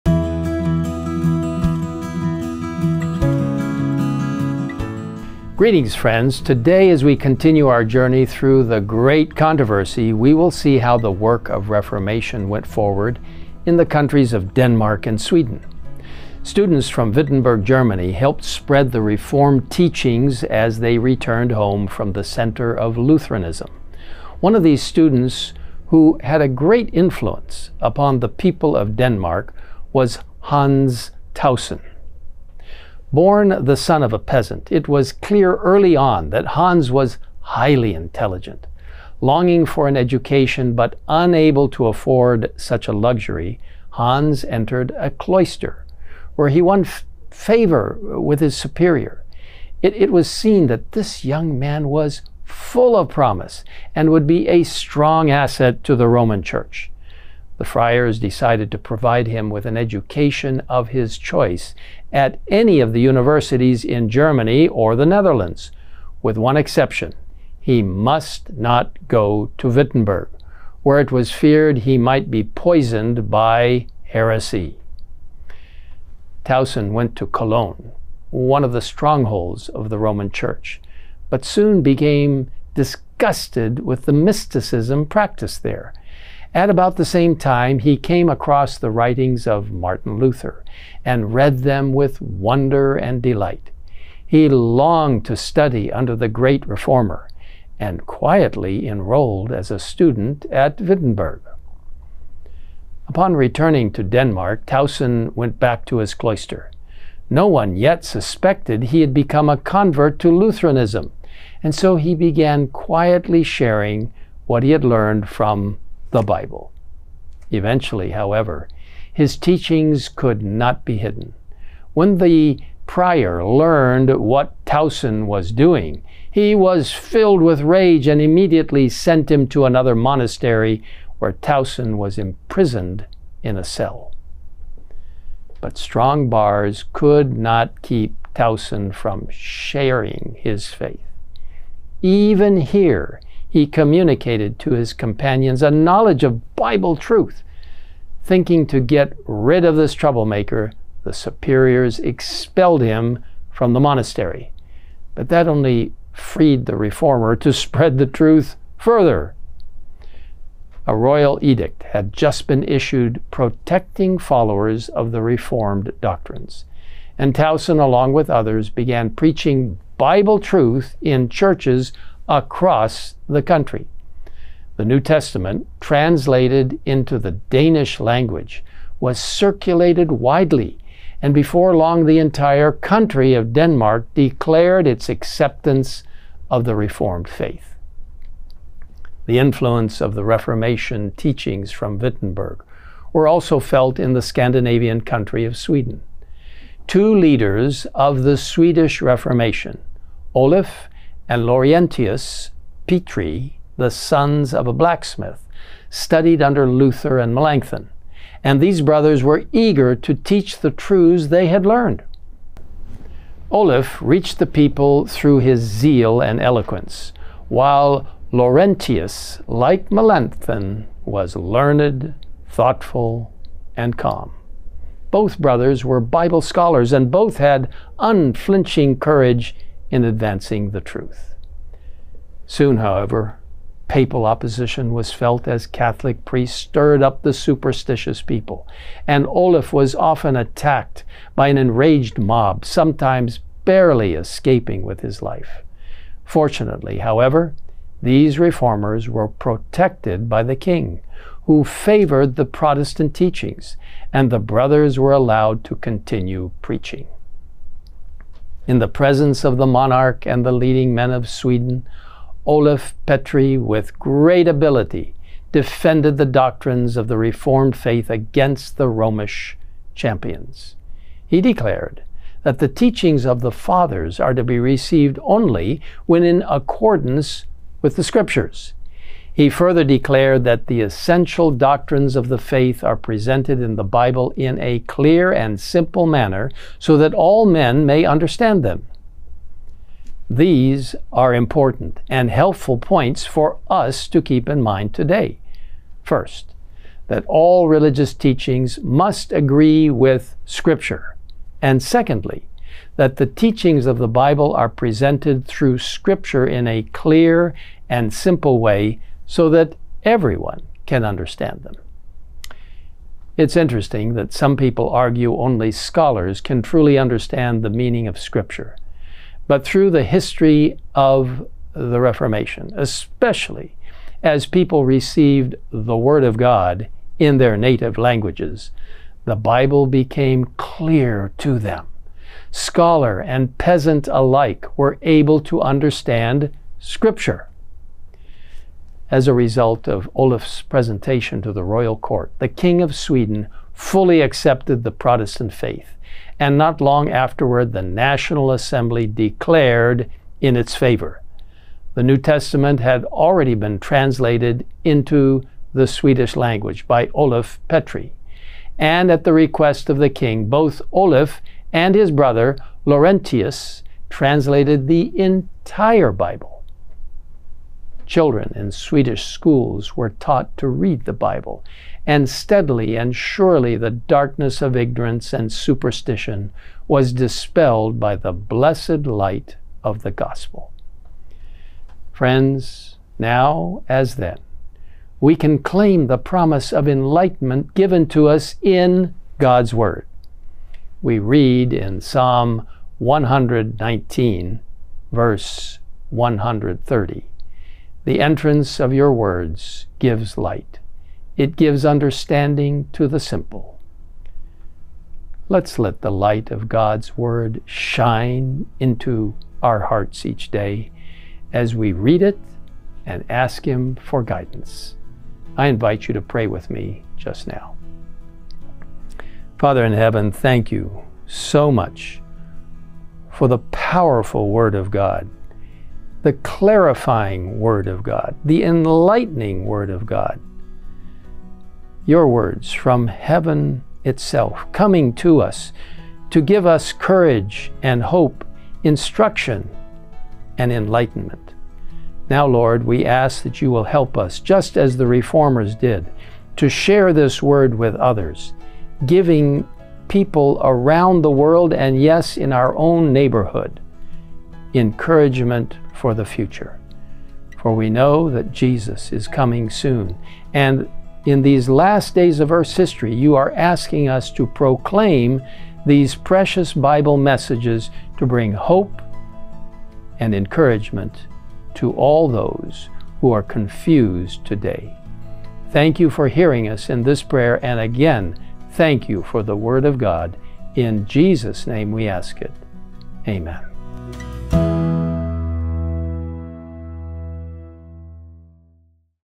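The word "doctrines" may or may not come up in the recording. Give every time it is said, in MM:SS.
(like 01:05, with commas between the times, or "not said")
02:46, 04:26, 04:41.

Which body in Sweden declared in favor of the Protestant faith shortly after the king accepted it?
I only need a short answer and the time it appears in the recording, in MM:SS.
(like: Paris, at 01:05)
The National Assembly, at 05:47.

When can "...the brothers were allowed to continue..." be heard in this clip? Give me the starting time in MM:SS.
04:14.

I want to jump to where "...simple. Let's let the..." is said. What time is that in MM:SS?
06:43.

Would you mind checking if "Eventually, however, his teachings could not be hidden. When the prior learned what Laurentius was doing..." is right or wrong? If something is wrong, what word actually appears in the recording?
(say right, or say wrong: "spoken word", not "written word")
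wrong: "Tausen", not "Laurentius".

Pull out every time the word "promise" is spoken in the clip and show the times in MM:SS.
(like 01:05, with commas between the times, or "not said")
00:53, 06:26.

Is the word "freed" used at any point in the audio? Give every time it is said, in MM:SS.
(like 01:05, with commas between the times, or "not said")
02:36.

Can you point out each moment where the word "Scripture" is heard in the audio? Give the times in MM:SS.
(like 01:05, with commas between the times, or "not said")
04:38, 05:00, 05:05, 05:18, 05:36.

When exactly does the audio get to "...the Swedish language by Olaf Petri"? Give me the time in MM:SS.
05:55.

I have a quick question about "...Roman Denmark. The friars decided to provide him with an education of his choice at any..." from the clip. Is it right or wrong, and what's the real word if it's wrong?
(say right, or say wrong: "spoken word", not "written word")
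wrong: "Church", not "Denmark".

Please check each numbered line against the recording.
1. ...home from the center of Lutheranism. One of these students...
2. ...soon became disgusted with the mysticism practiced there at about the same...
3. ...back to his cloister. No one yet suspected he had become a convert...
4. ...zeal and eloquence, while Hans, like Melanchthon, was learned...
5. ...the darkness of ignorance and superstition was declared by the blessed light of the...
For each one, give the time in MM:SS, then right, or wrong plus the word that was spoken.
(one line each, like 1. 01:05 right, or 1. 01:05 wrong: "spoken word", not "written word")
1. 00:21 right
2. 01:21 right
3. 01:45 right
4. 03:35 wrong: "Laurentius", not "Hans"
5. 06:13 wrong: "dispelled", not "declared".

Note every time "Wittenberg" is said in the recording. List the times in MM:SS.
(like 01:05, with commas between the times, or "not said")
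00:17, 01:09, 01:40, 03:11.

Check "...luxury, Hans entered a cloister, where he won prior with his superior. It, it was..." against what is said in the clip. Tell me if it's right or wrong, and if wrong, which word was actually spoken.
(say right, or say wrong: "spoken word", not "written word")
wrong: "favor", not "prior".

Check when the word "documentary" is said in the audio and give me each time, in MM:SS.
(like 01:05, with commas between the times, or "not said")
not said.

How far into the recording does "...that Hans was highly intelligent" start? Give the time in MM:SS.
00:36.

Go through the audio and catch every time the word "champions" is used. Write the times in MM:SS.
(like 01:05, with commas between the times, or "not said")
04:29.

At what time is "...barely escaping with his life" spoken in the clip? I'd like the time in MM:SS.
04:03.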